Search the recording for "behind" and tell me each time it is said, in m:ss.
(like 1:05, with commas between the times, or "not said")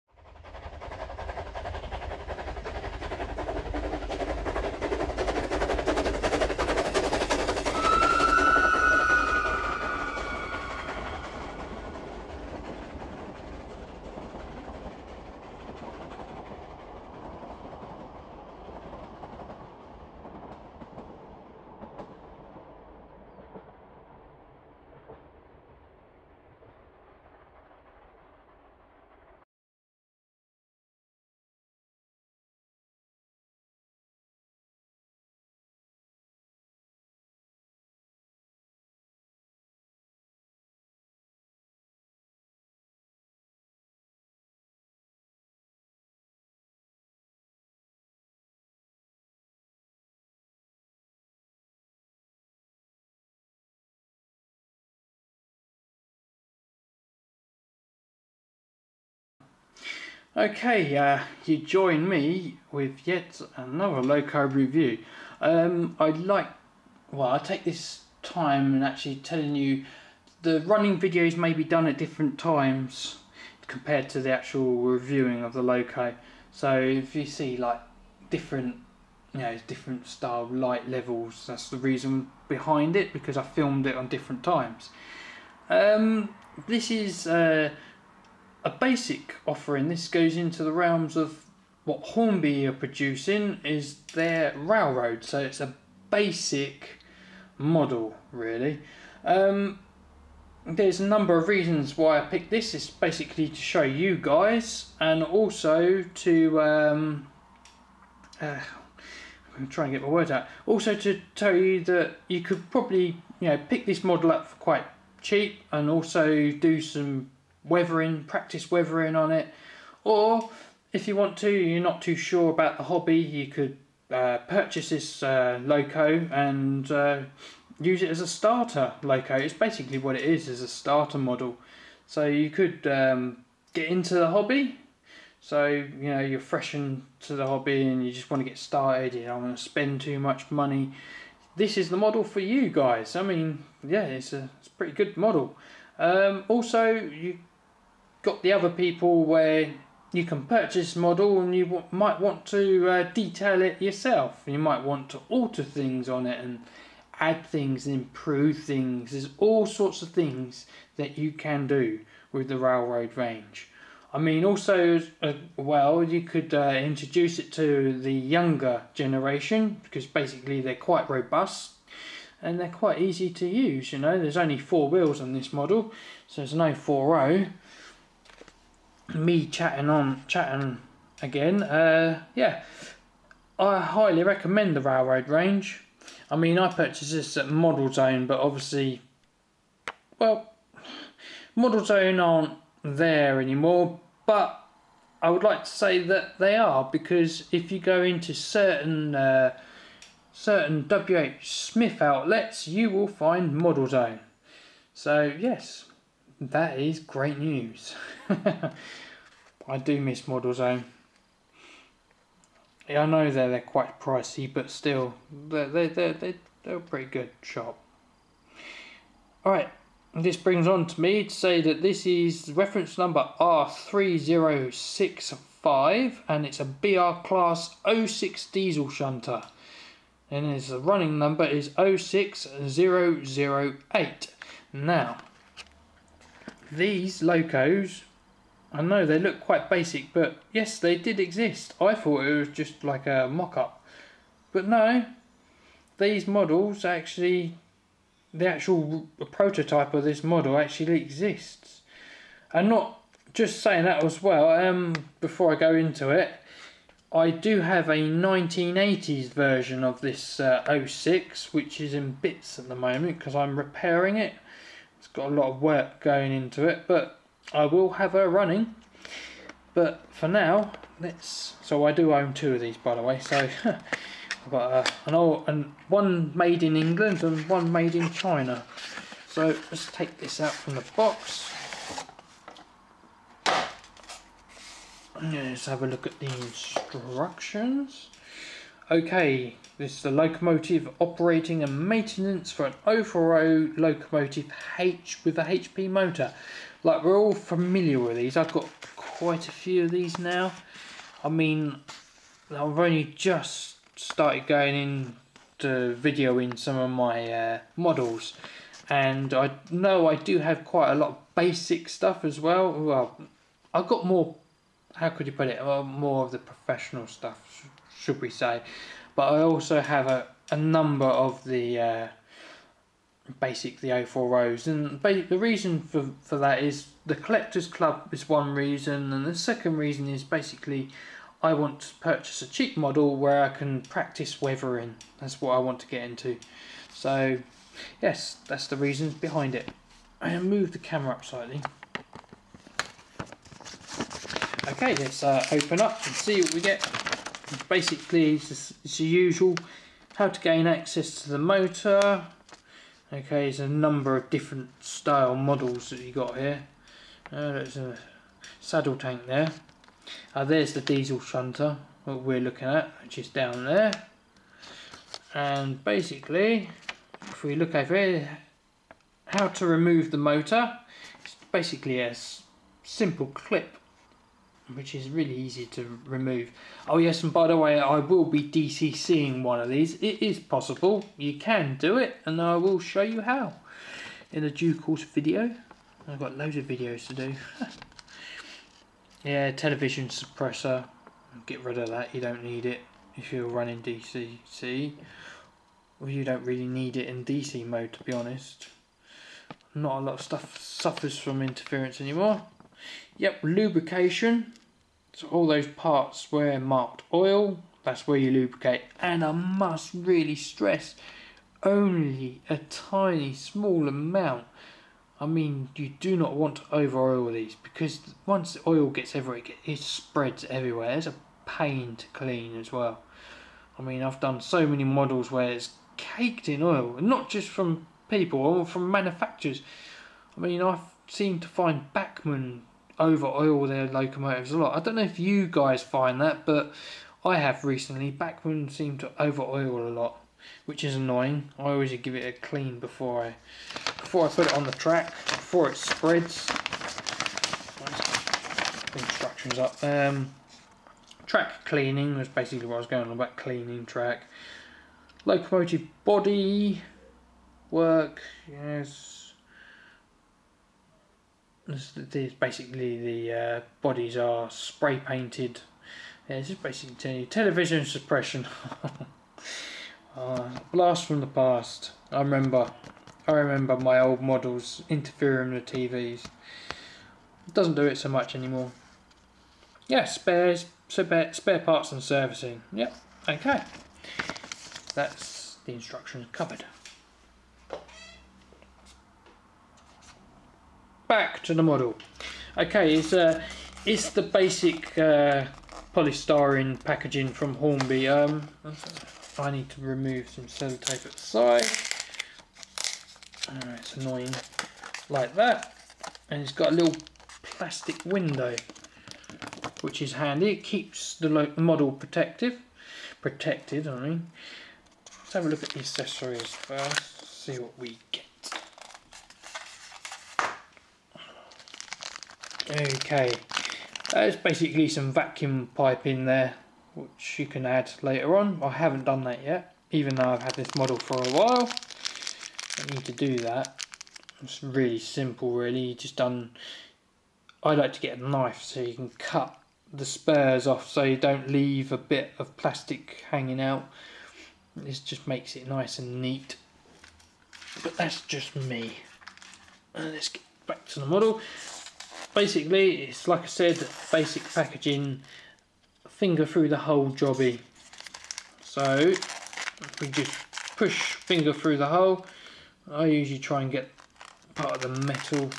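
1:22, 5:39.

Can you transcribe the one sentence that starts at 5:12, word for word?
Well, I've got more, how could you put it, more of the professional stuff should we say.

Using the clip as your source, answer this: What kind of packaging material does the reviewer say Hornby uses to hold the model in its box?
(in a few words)
polystyrene.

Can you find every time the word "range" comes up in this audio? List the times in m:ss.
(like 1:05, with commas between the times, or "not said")
2:43, 3:05.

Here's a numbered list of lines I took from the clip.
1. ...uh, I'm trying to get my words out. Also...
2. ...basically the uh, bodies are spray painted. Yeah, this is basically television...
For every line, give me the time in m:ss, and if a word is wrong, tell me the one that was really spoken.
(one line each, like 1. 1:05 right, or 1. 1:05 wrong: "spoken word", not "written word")
1. 1:48 right
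2. 7:42 right.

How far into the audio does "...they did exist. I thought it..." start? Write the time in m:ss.
4:00.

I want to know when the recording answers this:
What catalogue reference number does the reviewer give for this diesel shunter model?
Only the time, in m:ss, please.
3:43.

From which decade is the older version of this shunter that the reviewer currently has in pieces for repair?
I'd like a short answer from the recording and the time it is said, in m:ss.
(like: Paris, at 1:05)
1980s, at 4:17.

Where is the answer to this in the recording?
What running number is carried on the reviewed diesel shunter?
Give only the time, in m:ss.
3:51.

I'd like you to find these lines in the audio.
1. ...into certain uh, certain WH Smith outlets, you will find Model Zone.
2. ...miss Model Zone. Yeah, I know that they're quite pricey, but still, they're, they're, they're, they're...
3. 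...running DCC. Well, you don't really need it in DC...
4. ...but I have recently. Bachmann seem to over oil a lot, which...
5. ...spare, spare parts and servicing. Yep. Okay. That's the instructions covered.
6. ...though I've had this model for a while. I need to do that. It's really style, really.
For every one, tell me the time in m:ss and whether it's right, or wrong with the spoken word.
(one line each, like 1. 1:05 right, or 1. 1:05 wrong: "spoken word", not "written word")
1. 3:18 right
2. 3:30 right
3. 6:33 right
4. 7:16 right
5. 8:00 right
6. 8:50 wrong: "simple", not "style".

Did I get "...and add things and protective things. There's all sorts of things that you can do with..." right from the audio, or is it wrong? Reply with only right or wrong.
wrong.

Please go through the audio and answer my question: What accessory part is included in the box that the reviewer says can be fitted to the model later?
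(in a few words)
vacuum pipe.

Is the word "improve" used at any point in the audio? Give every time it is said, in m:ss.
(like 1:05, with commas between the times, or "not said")
2:37.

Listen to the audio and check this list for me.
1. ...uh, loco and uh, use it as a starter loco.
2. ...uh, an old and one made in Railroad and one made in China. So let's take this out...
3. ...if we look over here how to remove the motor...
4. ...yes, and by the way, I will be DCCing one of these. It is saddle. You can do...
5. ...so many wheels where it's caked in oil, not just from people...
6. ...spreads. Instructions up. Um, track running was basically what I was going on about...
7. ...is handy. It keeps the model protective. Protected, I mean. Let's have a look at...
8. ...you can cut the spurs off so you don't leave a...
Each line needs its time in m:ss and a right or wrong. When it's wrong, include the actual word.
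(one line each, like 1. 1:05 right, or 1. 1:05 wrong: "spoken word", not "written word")
1. 2:05 right
2. 4:34 wrong: "England", not "Railroad"
3. 6:07 right
4. 6:16 wrong: "possible", not "saddle"
5. 7:04 wrong: "models", not "wheels"
6. 7:25 wrong: "cleaning", not "running"
7. 8:30 right
8. 8:58 right.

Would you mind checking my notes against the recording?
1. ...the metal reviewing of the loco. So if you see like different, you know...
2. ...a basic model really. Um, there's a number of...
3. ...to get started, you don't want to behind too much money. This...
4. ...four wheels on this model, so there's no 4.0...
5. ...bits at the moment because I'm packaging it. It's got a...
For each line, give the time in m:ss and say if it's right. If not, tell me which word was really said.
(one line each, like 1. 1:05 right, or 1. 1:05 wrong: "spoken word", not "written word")
1. 1:14 wrong: "actual", not "metal"
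2. 1:35 right
3. 2:18 wrong: "spend", not "behind"
4. 2:54 right
5. 4:22 wrong: "repairing", not "packaging".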